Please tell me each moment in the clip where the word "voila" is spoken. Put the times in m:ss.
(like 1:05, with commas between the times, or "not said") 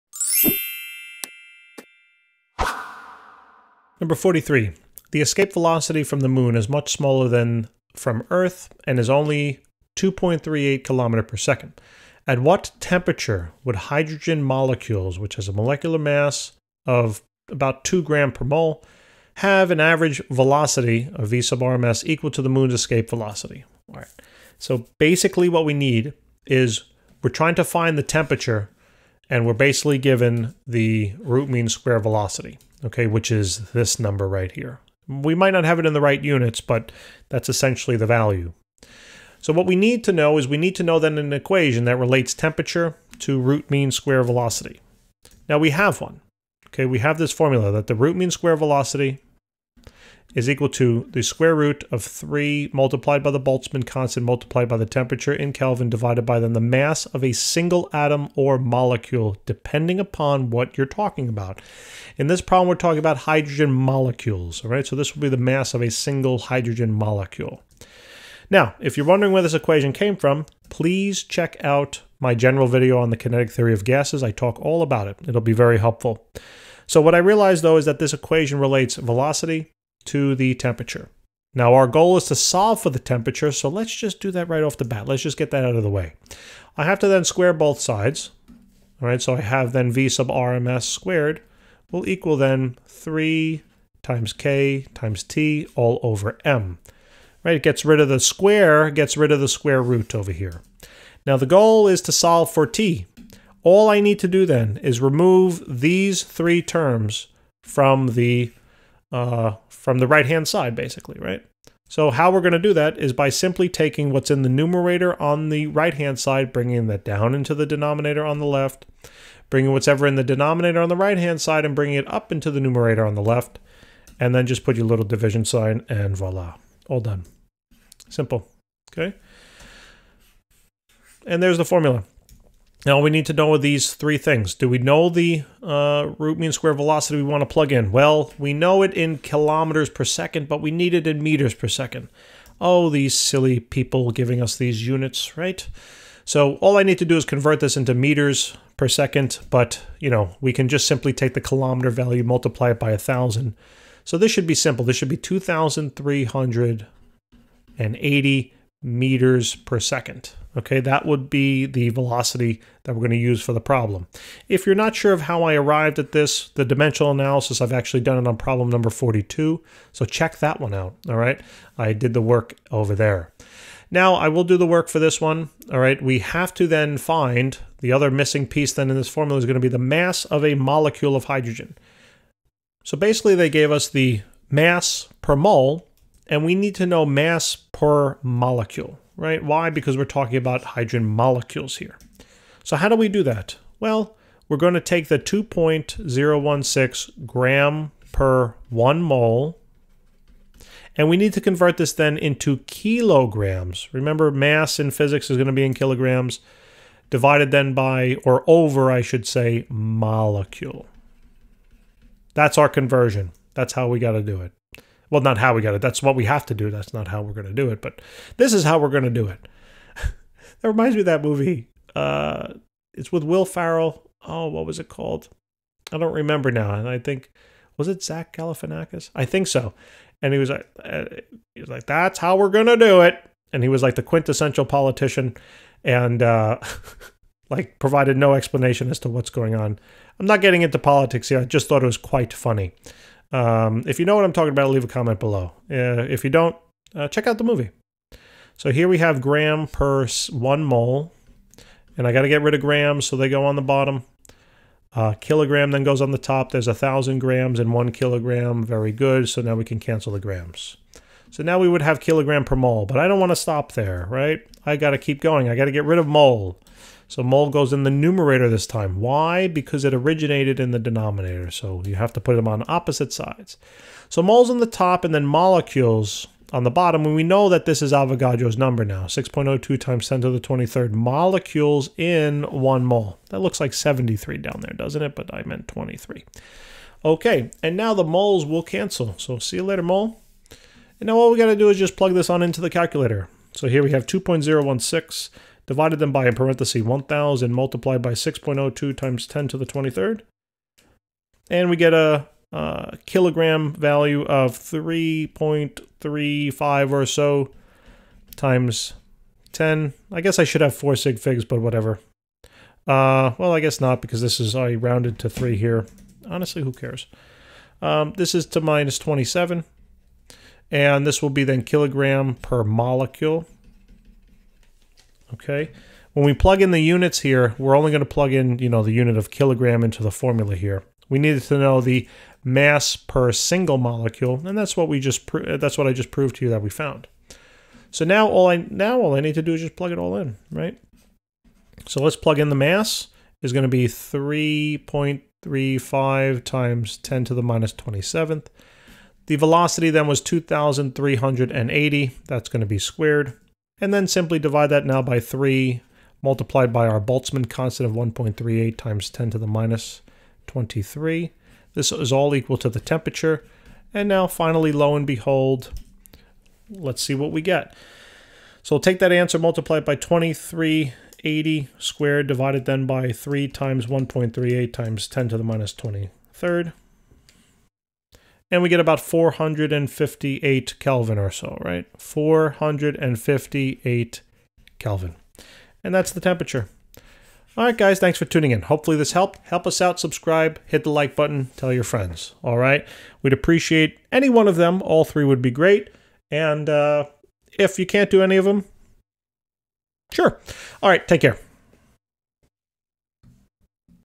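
2:06.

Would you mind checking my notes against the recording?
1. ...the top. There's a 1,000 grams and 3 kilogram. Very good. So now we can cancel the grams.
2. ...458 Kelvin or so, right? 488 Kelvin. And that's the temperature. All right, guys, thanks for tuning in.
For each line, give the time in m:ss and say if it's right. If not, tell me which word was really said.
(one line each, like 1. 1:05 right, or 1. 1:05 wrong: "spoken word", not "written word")
1. 4:16 wrong: "1", not "3"
2. 6:18 wrong: "458", not "488".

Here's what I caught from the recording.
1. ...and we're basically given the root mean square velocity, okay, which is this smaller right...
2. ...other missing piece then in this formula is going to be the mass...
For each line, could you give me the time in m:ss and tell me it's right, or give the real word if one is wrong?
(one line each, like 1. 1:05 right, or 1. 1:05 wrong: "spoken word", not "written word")
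1. 0:29 wrong: "number", not "smaller"
2. 2:57 right.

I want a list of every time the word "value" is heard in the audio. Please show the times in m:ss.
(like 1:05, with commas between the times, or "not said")
0:38, 2:31, 5:03.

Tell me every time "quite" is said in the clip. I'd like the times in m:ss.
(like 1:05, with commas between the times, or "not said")
4:01.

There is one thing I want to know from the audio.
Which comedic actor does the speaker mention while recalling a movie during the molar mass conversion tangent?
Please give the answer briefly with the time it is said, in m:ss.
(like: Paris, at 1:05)
Will Ferrell, at 3:43.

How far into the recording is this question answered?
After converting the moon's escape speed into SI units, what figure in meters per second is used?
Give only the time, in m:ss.
2:35.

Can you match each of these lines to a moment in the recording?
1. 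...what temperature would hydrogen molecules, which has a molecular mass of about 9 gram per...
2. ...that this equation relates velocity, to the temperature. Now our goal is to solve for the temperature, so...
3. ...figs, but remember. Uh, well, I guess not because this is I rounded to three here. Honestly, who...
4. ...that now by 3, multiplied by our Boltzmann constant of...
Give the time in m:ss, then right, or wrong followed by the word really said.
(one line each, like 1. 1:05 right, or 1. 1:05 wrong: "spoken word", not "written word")
1. 0:12 wrong: "2", not "9"
2. 1:17 right
3. 5:11 wrong: "whatever", not "remember"
4. 5:54 right.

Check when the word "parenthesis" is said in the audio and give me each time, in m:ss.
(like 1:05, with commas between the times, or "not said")
4:56.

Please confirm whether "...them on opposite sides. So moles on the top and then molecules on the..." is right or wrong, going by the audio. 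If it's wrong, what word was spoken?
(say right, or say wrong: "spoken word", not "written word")
right.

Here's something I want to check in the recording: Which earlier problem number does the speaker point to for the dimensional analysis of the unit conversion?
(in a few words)
42.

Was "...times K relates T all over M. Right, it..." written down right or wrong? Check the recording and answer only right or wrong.
wrong.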